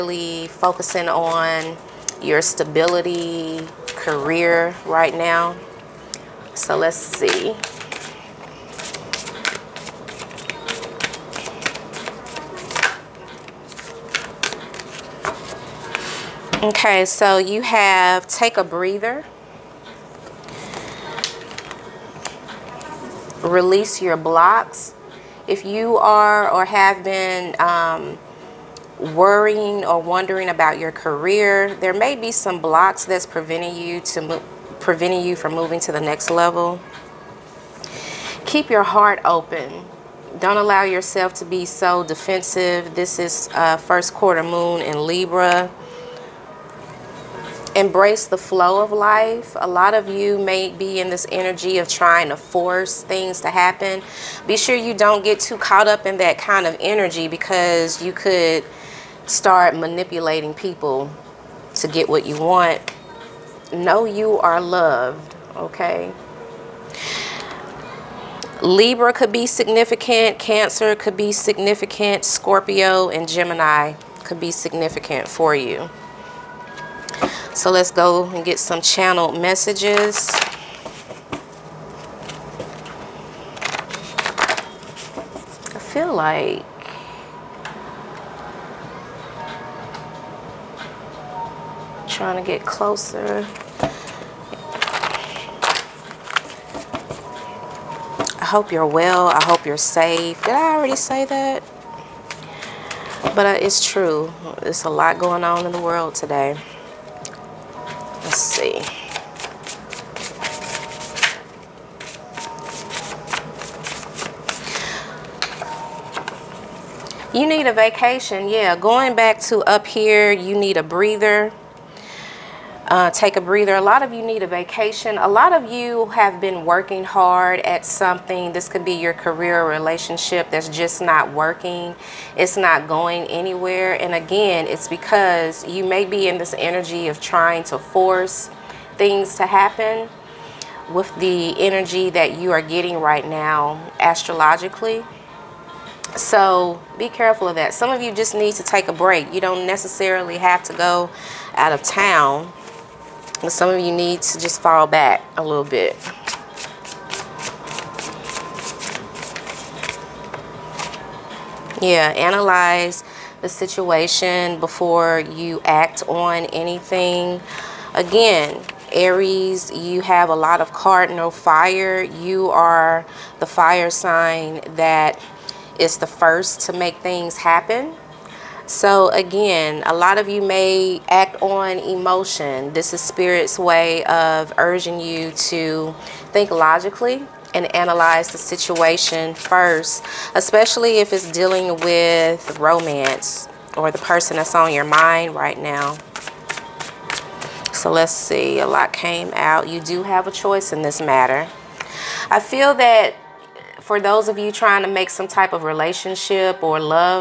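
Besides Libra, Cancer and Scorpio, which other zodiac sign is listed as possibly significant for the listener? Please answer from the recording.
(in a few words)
Gemini.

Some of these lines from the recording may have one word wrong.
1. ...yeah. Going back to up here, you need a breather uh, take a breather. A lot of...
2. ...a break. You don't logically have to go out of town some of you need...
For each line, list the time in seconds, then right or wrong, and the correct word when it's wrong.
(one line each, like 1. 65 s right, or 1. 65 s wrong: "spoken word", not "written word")
1. 118 s right
2. 148 s wrong: "necessarily", not "logically".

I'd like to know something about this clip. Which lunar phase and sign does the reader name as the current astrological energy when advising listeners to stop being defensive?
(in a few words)
First quarter moon in Libra.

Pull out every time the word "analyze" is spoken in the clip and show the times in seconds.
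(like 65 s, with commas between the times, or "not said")
162 s, 187 s.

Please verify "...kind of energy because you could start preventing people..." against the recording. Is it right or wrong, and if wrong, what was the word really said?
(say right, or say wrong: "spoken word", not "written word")
wrong: "manipulating", not "preventing".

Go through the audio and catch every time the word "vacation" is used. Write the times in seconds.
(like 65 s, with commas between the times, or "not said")
117 s, 124 s.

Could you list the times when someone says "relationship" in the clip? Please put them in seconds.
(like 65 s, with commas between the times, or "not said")
129 s, 205 s.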